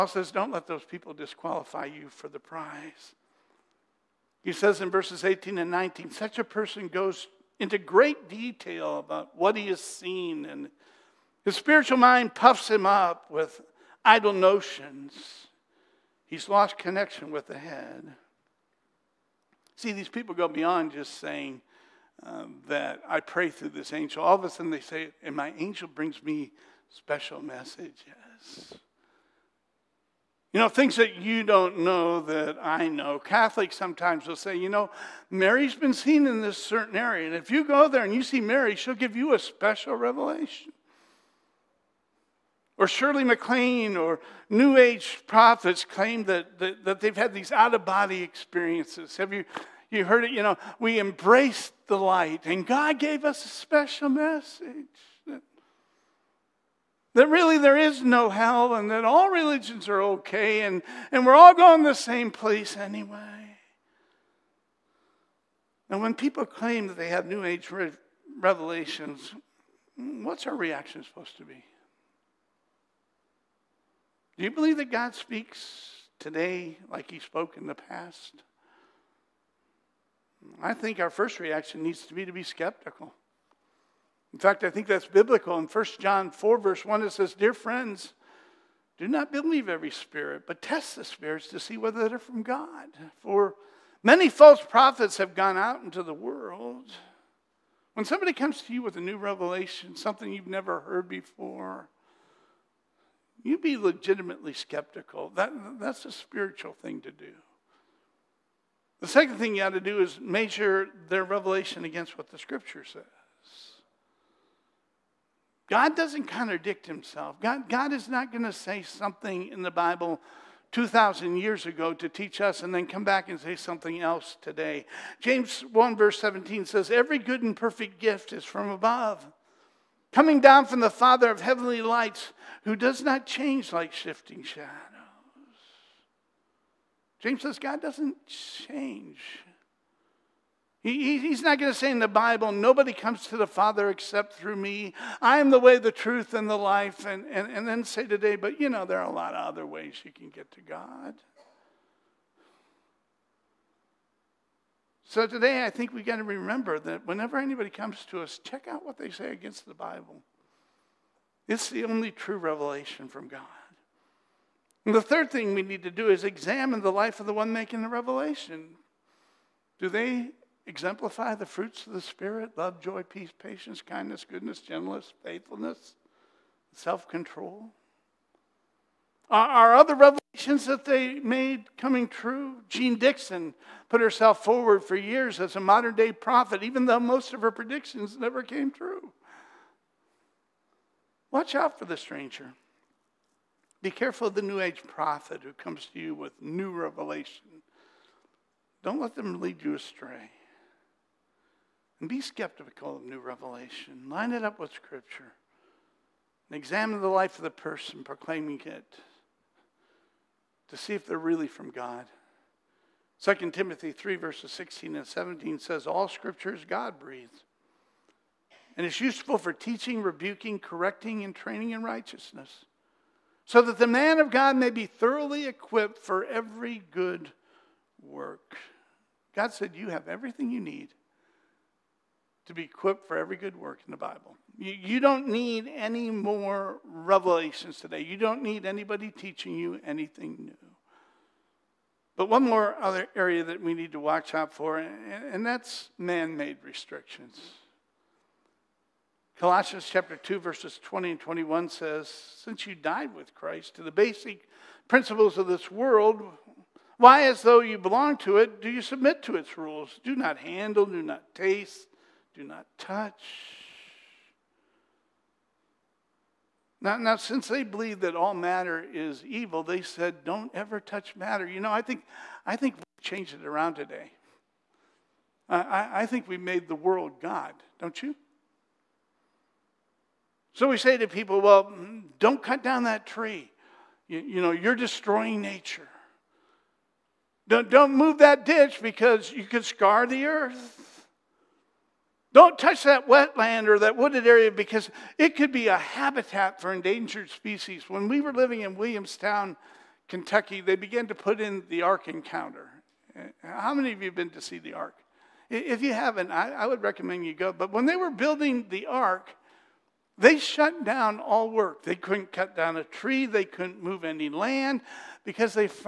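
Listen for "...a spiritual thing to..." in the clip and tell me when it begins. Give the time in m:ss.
1:46.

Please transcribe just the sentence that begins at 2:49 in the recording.
Do they exemplify the fruits of the Spirit love, joy, peace, patience, kindness, goodness, gentleness, faithfulness, self control?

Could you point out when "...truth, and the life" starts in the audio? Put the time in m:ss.
2:25.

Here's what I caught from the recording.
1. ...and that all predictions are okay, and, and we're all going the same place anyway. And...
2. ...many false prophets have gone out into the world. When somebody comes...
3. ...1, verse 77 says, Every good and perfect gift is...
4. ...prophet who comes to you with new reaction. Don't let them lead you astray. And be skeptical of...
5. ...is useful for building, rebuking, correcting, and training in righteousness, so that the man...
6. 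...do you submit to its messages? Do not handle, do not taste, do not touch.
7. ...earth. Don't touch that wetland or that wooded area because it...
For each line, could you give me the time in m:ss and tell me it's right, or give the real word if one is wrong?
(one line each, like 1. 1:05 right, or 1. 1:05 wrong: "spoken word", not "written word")
1. 0:58 wrong: "religions", not "predictions"
2. 1:34 right
3. 2:05 wrong: "17", not "77"
4. 3:14 wrong: "revelation", not "reaction"
5. 3:38 wrong: "teaching", not "building"
6. 4:18 wrong: "rules", not "messages"
7. 4:50 right.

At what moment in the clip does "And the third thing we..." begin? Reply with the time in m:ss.
2:44.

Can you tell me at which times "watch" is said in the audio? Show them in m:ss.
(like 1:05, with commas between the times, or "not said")
3:11, 4:03.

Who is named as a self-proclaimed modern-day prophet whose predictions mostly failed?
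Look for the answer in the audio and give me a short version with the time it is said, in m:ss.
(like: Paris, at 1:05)
Jeane Dixon, at 3:02.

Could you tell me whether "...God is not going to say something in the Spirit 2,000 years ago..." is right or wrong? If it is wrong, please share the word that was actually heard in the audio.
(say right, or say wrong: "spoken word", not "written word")
wrong: "Bible", not "Spirit".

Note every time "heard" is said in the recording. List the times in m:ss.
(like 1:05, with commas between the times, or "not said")
0:50, 1:40.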